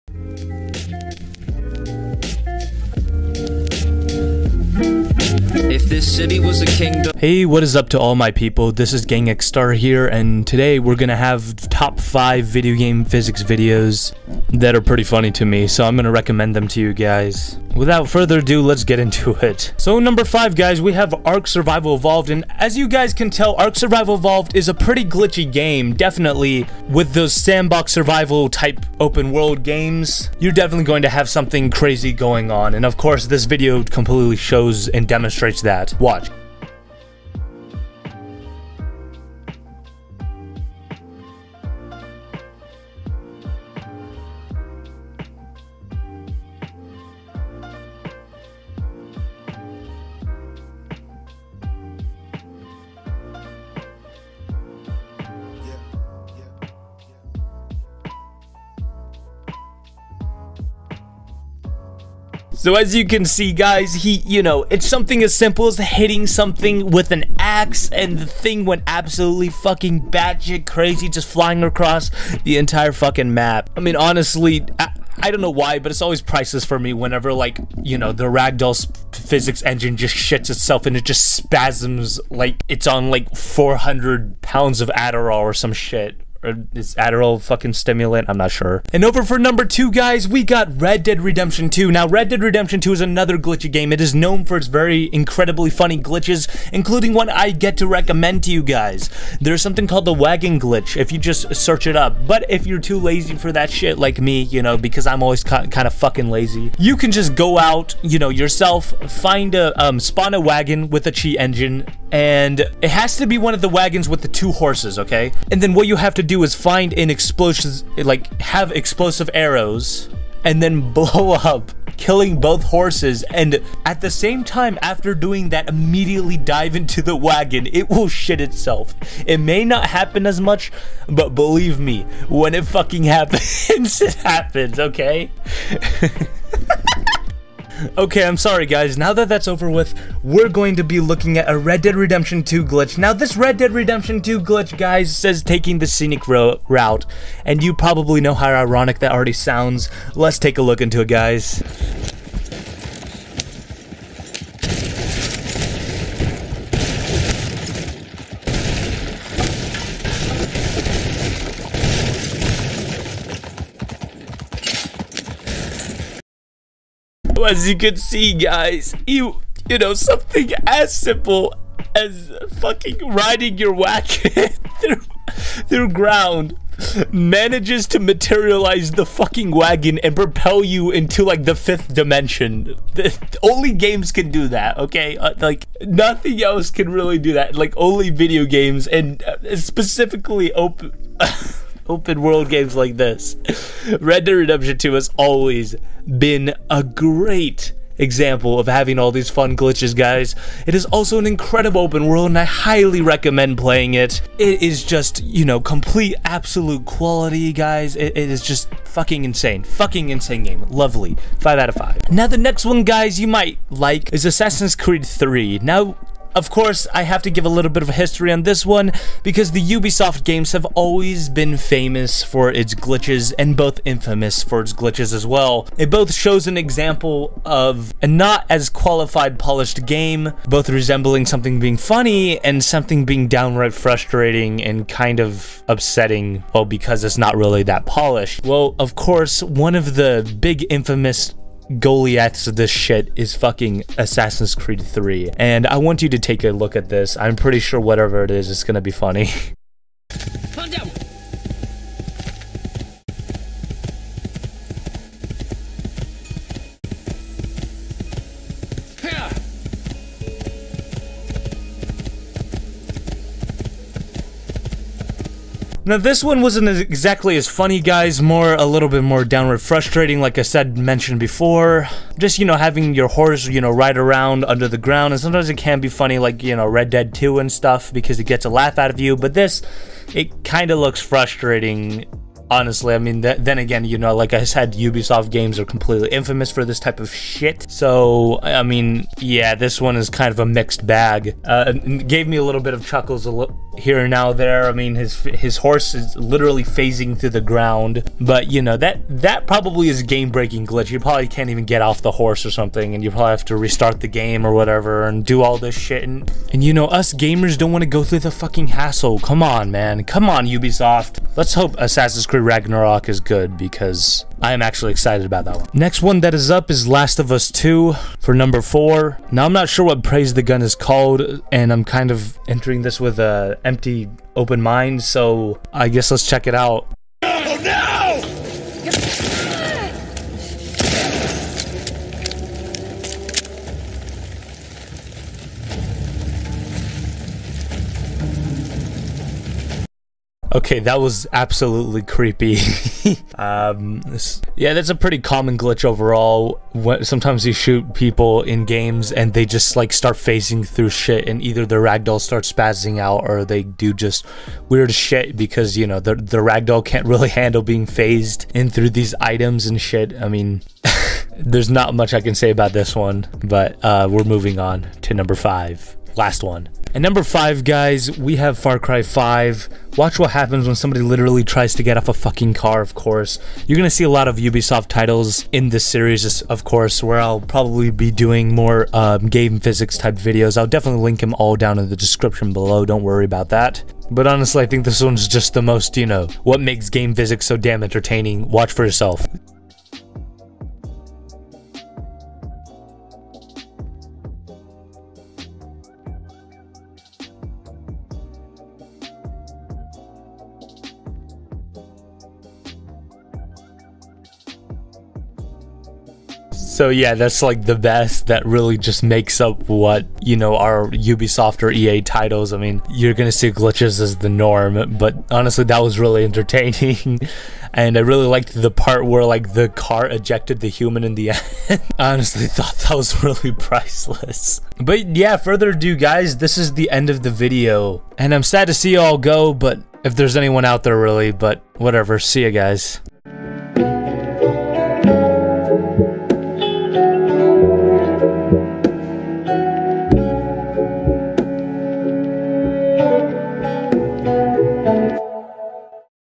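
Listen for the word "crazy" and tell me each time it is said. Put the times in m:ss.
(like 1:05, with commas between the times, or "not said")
0:31, 1:10.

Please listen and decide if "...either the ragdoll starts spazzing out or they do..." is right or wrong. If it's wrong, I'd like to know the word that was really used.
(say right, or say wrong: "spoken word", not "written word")
right.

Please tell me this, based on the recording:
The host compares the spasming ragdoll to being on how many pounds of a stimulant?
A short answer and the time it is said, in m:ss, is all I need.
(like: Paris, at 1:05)
400, at 1:23.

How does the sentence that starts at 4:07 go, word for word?
I'm pretty sure whatever it is, it's gonna be funny.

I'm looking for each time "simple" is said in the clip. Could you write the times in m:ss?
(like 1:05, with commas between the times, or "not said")
1:05, 2:50.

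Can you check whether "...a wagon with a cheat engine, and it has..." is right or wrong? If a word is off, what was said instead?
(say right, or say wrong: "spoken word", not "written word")
right.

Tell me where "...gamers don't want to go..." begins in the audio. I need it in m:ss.
5:07.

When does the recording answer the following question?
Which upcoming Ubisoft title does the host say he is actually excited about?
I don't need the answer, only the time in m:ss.
5:11.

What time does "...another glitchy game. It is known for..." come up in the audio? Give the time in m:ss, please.
1:33.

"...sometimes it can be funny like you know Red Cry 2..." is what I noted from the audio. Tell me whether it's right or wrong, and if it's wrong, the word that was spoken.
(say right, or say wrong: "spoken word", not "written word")
wrong: "Dead", not "Cry".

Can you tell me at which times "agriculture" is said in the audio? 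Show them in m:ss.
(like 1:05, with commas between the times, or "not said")
not said.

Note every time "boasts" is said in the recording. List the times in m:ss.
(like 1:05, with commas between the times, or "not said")
not said.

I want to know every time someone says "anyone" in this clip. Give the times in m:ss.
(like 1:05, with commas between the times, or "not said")
7:10.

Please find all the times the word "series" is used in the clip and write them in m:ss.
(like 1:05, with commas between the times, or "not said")
6:15.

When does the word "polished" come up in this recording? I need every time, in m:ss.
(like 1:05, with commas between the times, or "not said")
3:49, 3:57.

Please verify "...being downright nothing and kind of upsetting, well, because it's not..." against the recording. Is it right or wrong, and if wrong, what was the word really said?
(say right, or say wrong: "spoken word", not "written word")
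wrong: "frustrating", not "nothing".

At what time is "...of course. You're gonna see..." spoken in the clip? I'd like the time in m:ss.
6:12.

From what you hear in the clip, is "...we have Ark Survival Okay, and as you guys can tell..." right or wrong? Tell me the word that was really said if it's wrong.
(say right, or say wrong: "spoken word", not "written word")
wrong: "Evolved", not "Okay".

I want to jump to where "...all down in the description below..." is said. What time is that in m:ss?
6:21.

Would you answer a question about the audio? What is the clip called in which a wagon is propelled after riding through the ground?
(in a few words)
Taking the scenic route.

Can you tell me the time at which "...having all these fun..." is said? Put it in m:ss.
3:18.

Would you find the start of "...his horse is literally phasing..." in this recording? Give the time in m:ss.
4:55.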